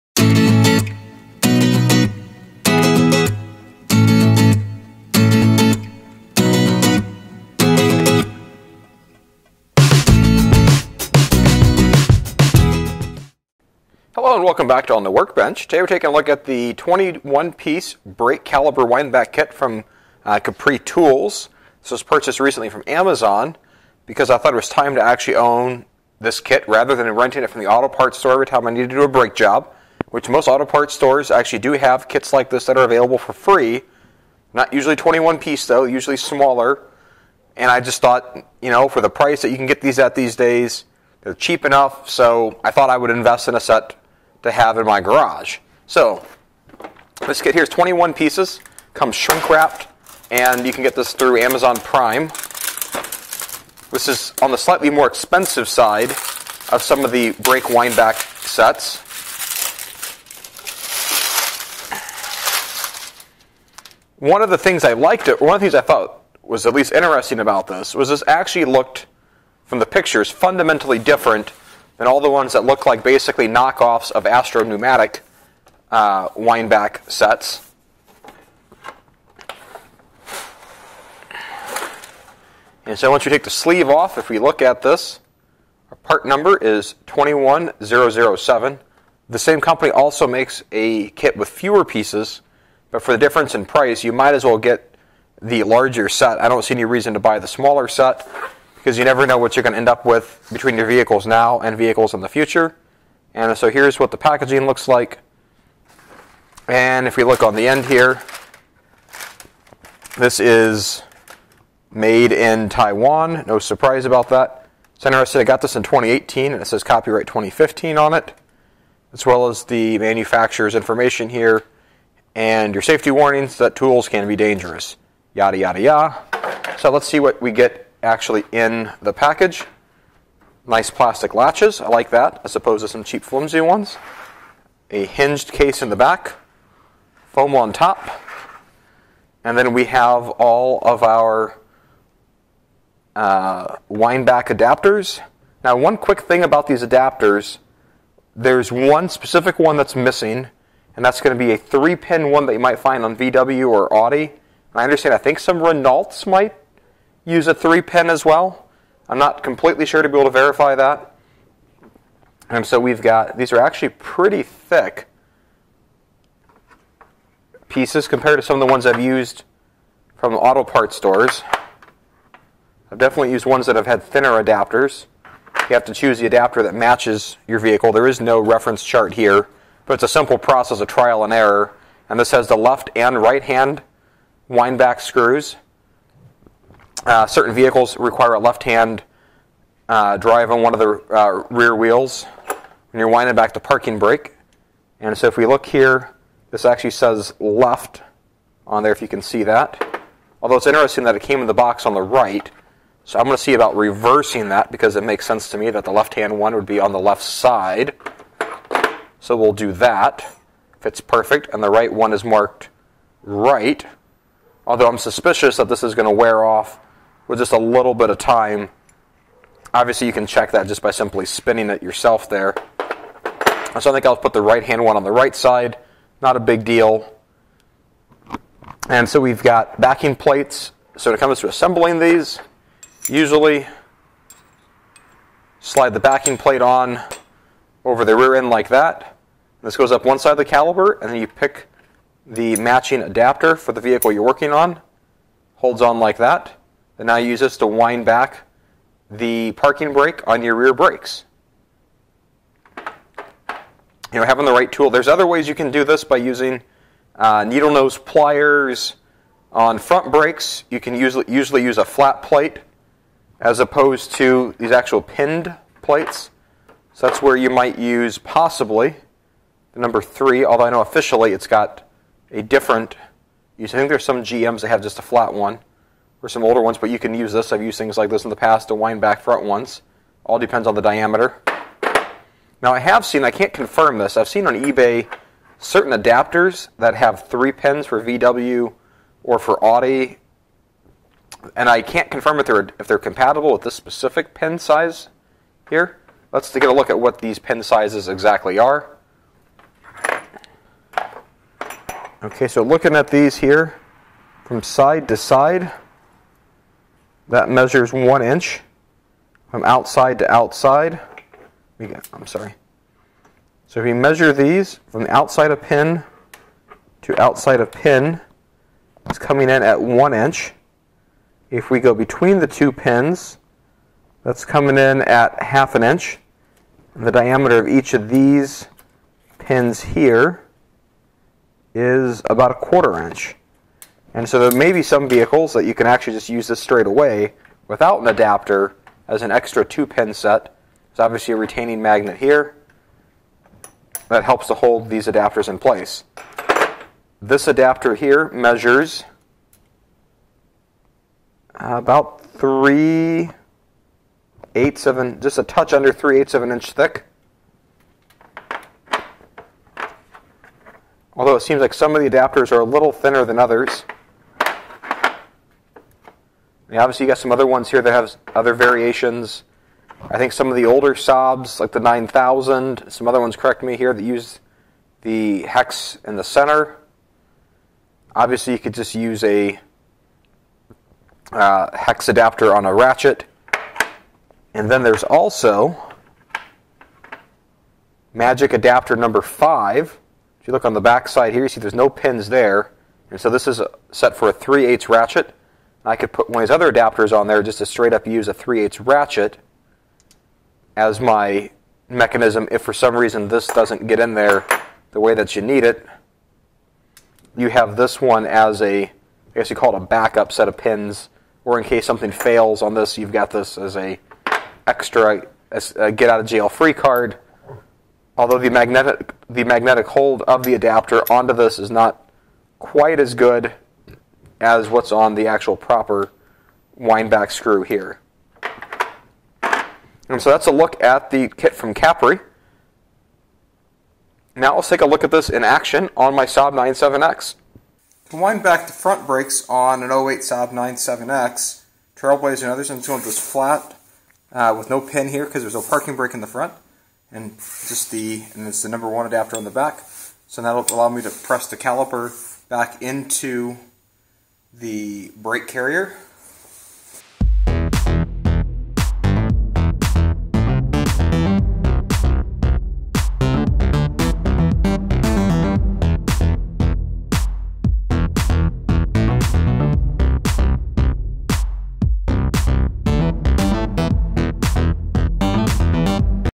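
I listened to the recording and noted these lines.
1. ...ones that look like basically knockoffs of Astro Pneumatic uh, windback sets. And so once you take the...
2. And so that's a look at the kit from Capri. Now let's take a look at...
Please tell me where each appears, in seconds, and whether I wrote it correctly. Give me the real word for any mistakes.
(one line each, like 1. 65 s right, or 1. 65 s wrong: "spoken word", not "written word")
1. 72 s right
2. 430 s right.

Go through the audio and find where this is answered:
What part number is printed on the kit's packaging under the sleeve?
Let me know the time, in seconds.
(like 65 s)
87 s.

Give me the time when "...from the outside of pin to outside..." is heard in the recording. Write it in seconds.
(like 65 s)
314 s.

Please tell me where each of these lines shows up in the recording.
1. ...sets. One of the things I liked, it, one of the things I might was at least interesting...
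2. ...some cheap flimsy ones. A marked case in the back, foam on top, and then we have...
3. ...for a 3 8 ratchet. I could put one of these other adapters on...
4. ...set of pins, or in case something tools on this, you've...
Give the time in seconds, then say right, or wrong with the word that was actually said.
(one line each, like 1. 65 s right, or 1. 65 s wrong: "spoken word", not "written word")
1. 58 s wrong: "thought", not "might"
2. 132 s wrong: "hinged", not "marked"
3. 394 s right
4. 410 s wrong: "fails", not "tools".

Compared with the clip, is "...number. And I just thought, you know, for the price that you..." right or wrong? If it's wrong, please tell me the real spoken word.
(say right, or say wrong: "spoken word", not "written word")
wrong: "smaller", not "number".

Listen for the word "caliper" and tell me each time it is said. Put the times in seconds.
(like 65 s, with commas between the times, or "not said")
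18 s, 240 s, 451 s.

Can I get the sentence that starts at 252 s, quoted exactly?
You know, having the right tool.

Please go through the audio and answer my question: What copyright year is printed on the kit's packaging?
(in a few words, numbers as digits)
2015.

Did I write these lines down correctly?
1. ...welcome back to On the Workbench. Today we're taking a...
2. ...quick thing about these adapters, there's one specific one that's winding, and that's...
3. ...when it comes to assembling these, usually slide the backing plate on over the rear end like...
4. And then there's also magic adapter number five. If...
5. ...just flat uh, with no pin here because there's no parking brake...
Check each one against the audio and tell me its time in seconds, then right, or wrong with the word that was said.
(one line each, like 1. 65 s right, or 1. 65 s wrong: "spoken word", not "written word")
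1. 14 s right
2. 145 s wrong: "missing", not "winding"
3. 231 s right
4. 384 s right
5. 443 s right.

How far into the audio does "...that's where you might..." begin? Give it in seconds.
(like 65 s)
267 s.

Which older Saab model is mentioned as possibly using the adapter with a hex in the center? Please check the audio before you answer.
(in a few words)
9000.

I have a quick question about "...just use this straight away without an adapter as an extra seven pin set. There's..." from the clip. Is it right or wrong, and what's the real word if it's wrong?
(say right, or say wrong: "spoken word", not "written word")
wrong: "two", not "seven".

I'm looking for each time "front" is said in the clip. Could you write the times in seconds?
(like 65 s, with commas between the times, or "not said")
259 s, 279 s, 438 s, 446 s.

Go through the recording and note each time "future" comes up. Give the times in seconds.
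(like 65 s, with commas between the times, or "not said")
102 s.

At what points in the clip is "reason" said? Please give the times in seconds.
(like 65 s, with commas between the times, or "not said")
96 s, 402 s.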